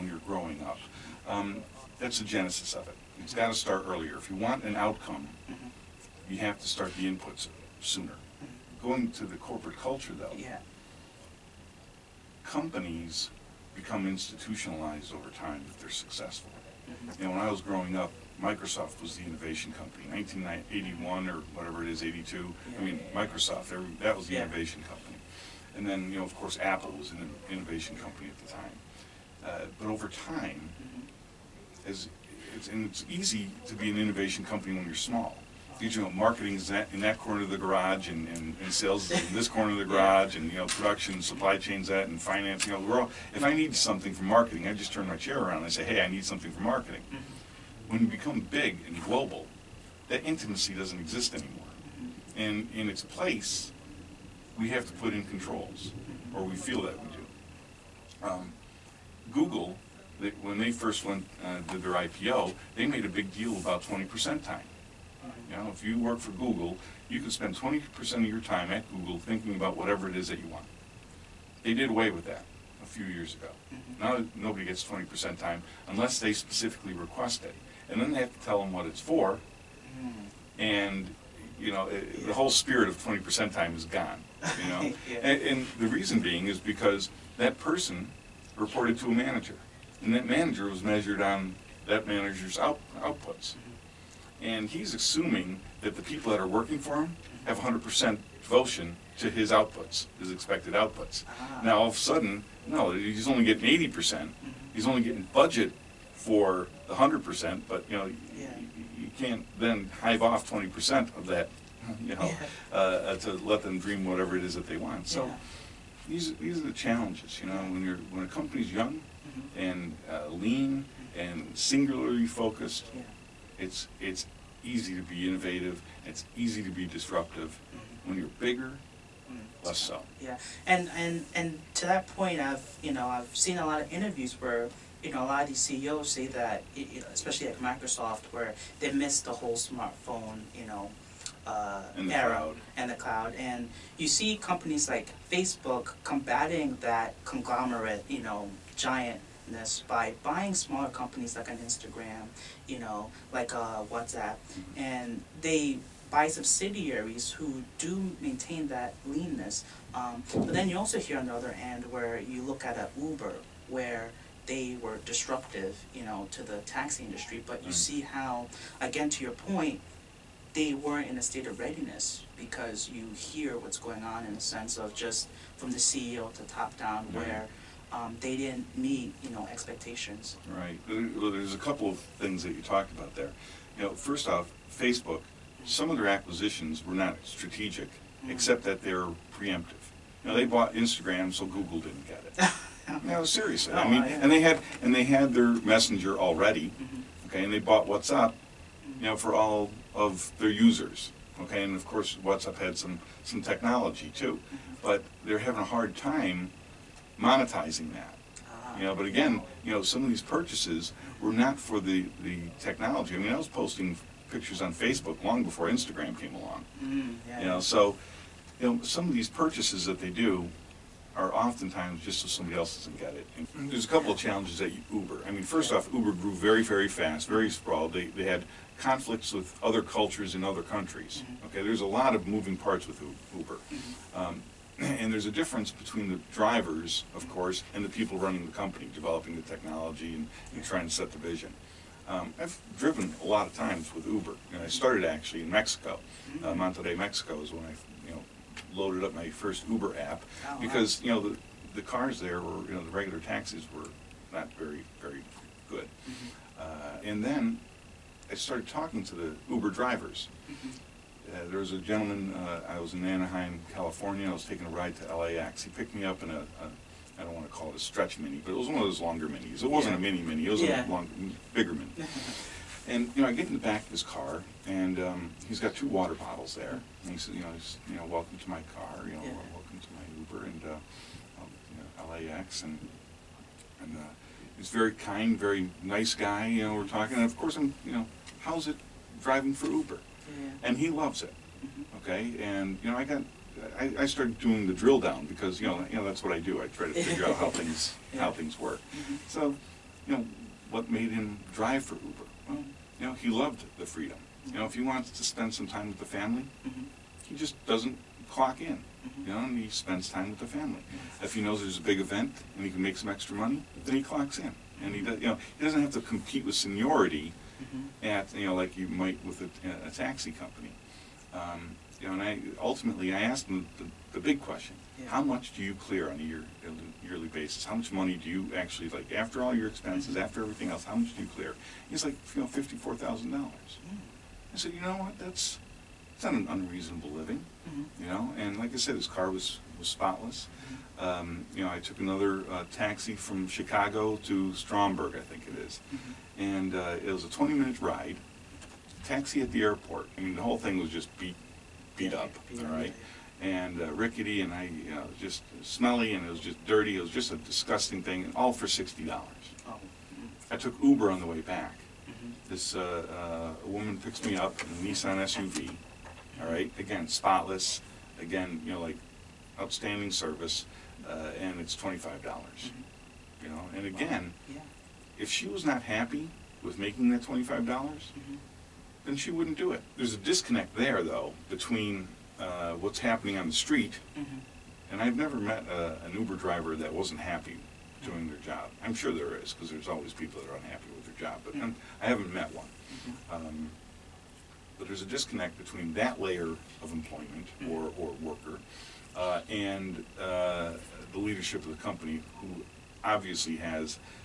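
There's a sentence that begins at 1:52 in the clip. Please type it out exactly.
uh, to let them dream whatever it is that they want.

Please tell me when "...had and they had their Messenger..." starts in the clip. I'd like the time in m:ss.
3:14.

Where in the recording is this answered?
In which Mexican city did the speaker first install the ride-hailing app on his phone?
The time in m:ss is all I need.
4:06.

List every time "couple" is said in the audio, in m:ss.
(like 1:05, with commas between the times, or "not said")
3:01, 3:43.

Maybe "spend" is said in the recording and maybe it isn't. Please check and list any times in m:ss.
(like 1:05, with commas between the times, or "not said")
1:07, 5:05, 5:09.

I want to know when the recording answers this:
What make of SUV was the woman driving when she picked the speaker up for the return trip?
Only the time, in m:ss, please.
6:04.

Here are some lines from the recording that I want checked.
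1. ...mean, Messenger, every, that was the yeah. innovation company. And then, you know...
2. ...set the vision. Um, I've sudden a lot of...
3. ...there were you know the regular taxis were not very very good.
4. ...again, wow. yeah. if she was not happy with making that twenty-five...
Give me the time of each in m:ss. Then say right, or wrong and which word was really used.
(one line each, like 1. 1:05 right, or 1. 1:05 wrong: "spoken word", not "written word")
1. 0:22 wrong: "Microsoft", not "Messenger"
2. 4:00 wrong: "driven", not "sudden"
3. 4:12 right
4. 6:13 right.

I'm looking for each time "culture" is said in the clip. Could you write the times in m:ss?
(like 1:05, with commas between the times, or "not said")
0:09, 3:49.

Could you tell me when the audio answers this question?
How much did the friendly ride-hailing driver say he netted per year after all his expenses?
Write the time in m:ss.
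5:32.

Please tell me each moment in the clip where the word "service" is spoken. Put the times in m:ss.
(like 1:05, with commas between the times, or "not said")
6:10.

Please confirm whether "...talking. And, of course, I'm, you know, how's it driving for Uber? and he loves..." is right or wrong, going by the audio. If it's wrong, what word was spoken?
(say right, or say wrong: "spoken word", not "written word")
right.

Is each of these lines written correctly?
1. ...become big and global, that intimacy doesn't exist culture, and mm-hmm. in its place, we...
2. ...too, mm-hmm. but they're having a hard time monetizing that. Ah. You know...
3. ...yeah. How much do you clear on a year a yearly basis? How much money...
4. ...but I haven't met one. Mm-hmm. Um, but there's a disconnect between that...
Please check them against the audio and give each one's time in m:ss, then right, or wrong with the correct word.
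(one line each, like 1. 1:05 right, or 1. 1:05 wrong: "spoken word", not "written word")
1. 0:48 wrong: "anymore", not "culture"
2. 3:24 right
3. 5:24 right
4. 6:31 right.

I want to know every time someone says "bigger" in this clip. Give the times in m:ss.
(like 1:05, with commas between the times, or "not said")
2:08, 4:31.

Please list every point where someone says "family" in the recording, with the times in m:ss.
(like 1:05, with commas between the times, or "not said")
5:06, 5:10.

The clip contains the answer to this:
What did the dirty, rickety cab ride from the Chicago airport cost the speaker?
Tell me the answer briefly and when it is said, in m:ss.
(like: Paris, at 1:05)
$60, at 5:58.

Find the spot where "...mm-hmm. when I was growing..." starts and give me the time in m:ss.
0:17.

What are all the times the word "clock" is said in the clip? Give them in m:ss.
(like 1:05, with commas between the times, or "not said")
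5:08, 5:14.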